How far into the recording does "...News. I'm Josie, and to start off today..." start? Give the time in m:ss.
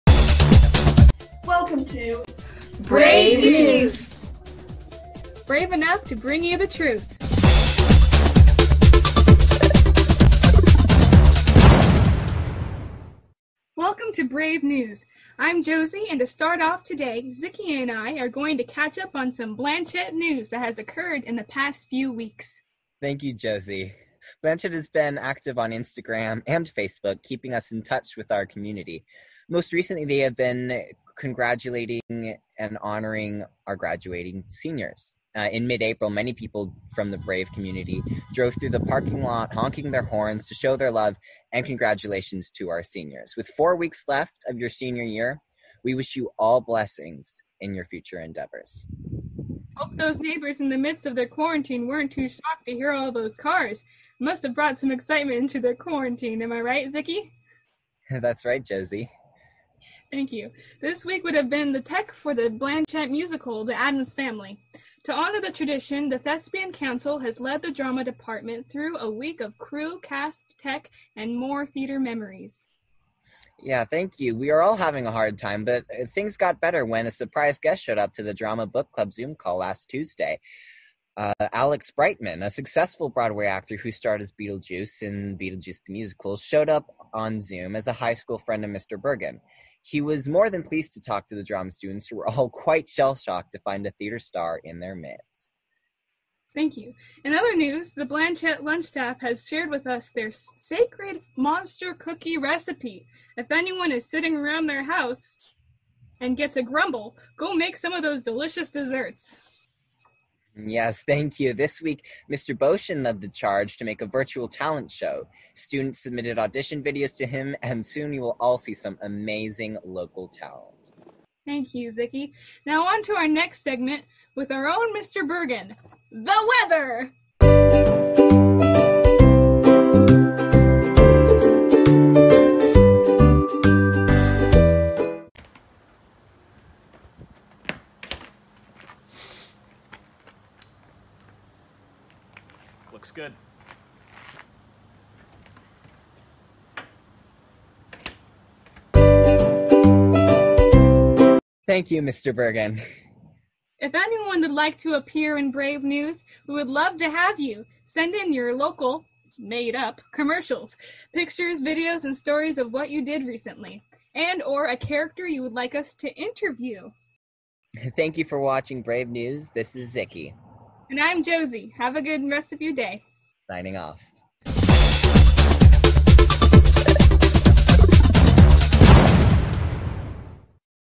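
0:14.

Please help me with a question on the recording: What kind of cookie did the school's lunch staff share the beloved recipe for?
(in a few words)
Monster cookie.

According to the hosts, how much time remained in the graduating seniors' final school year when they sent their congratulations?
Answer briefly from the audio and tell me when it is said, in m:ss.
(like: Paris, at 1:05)
4 weeks, at 0:43.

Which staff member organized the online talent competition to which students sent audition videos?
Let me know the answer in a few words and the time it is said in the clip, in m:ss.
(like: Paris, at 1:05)
Mr. Boshin, at 1:52.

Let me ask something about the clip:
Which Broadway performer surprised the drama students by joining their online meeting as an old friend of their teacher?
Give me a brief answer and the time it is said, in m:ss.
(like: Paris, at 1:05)
Alex Brightman, at 1:21.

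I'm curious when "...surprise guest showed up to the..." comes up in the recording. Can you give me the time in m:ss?
1:17.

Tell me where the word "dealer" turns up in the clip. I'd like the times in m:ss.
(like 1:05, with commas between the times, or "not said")
not said.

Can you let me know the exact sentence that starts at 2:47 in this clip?
Thank you for watching Brave News.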